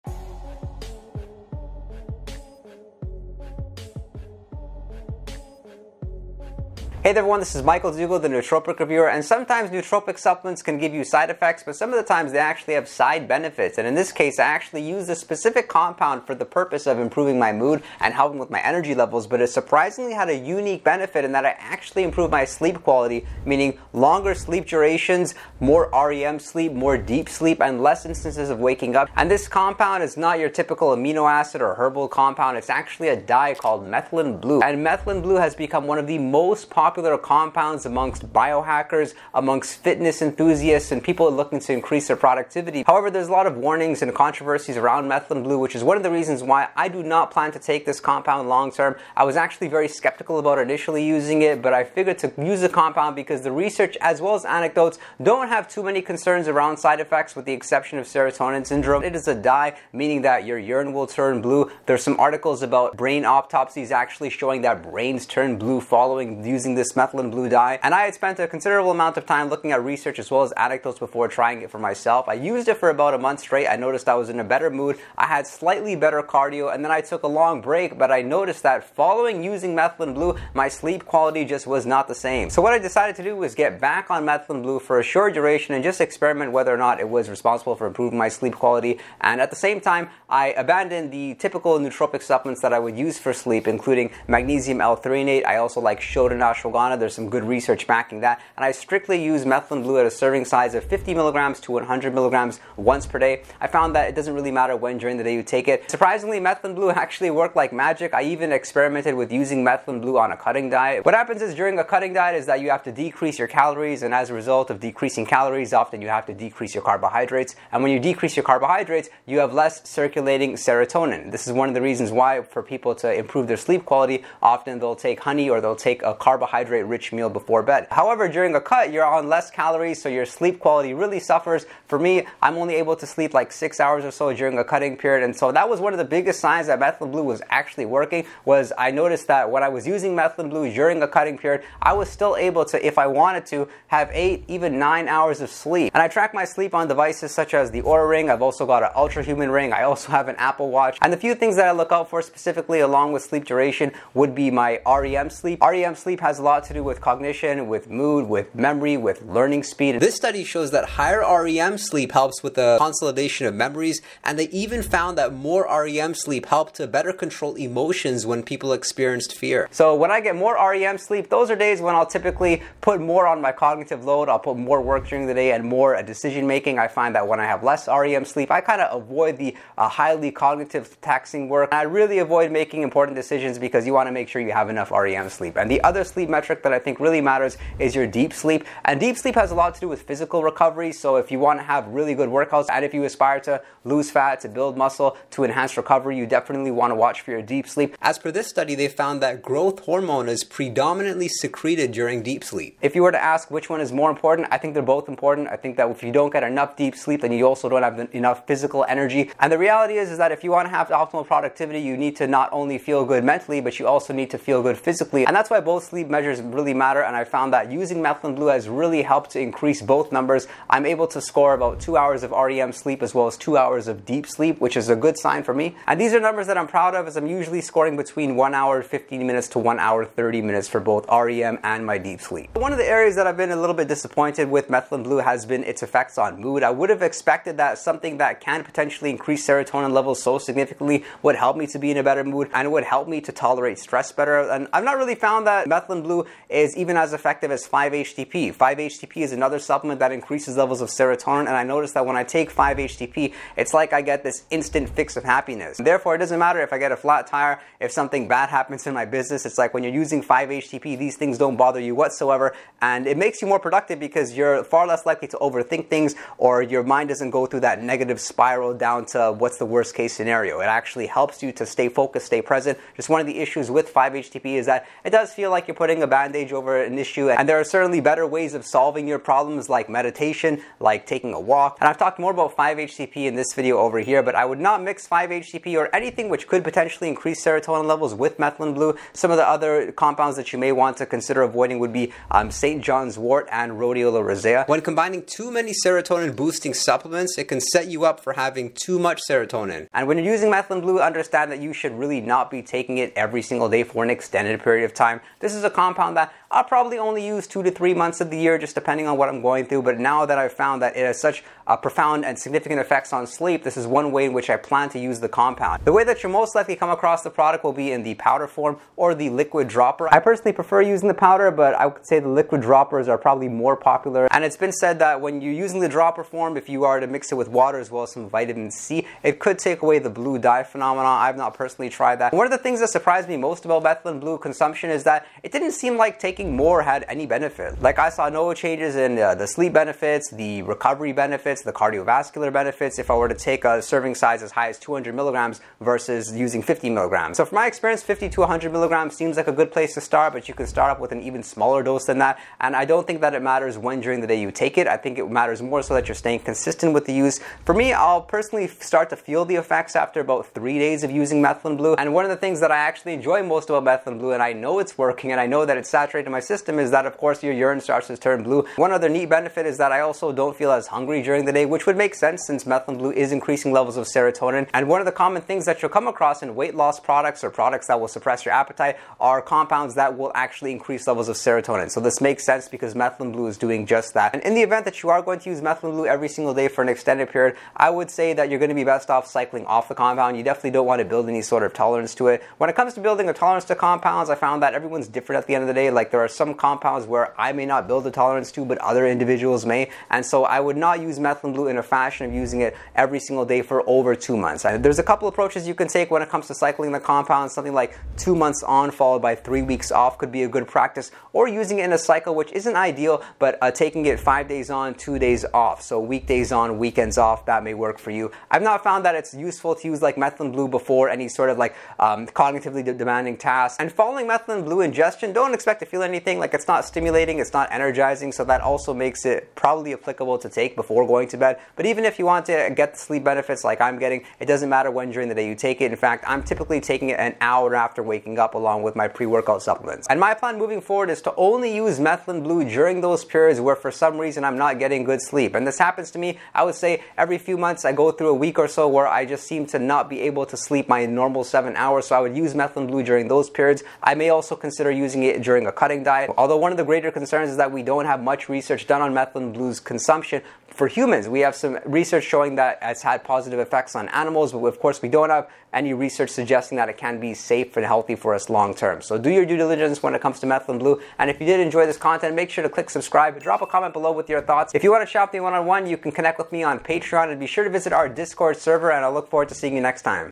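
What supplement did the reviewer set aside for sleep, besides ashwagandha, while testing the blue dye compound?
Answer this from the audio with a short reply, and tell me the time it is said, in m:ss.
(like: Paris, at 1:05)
magnesium L-threonate, at 1:34.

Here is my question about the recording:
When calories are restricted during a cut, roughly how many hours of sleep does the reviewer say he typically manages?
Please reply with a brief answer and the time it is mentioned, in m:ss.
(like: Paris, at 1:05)
6 hours, at 2:13.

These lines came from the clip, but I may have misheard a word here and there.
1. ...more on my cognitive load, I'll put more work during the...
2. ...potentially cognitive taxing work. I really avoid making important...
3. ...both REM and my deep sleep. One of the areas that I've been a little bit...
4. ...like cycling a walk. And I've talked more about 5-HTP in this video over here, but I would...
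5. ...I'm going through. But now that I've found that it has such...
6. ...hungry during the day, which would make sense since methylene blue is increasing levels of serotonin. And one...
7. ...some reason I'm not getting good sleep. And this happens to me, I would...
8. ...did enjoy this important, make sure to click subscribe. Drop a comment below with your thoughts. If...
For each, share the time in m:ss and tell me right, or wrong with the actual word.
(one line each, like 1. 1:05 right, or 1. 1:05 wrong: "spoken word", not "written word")
1. 2:52 right
2. 2:59 wrong: "highly", not "potentially"
3. 3:50 right
4. 4:40 wrong: "taking", not "cycling"
5. 5:09 right
6. 6:10 right
7. 7:23 right
8. 7:51 wrong: "content", not "important".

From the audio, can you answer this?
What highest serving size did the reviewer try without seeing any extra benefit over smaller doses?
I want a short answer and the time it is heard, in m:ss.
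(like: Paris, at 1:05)
200 milligrams, at 5:44.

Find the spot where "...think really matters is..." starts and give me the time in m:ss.
3:06.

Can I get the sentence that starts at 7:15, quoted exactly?
In fact, I'm typically taking it an hour after waking up along with my pre-workout supplements.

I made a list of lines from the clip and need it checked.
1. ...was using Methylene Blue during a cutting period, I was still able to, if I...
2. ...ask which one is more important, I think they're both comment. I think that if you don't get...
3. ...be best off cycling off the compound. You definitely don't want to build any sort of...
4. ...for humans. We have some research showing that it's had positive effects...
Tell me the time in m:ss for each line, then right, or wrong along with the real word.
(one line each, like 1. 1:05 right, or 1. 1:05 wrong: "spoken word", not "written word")
1. 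2:19 right
2. 3:23 wrong: "important", not "comment"
3. 6:28 right
4. 7:40 right.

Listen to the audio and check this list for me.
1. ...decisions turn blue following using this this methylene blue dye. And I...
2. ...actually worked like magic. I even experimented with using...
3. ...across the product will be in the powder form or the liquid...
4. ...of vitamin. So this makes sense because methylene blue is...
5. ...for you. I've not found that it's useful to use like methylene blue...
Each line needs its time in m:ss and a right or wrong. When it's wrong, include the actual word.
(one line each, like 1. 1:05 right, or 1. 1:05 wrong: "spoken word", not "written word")
1. 1:04 wrong: "brains", not "decisions"
2. 1:46 right
3. 5:16 right
4. 6:21 wrong: "serotonin", not "vitamin"
5. 6:57 right.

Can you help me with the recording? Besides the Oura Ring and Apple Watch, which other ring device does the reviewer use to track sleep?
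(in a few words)
Ultrahuman Ring.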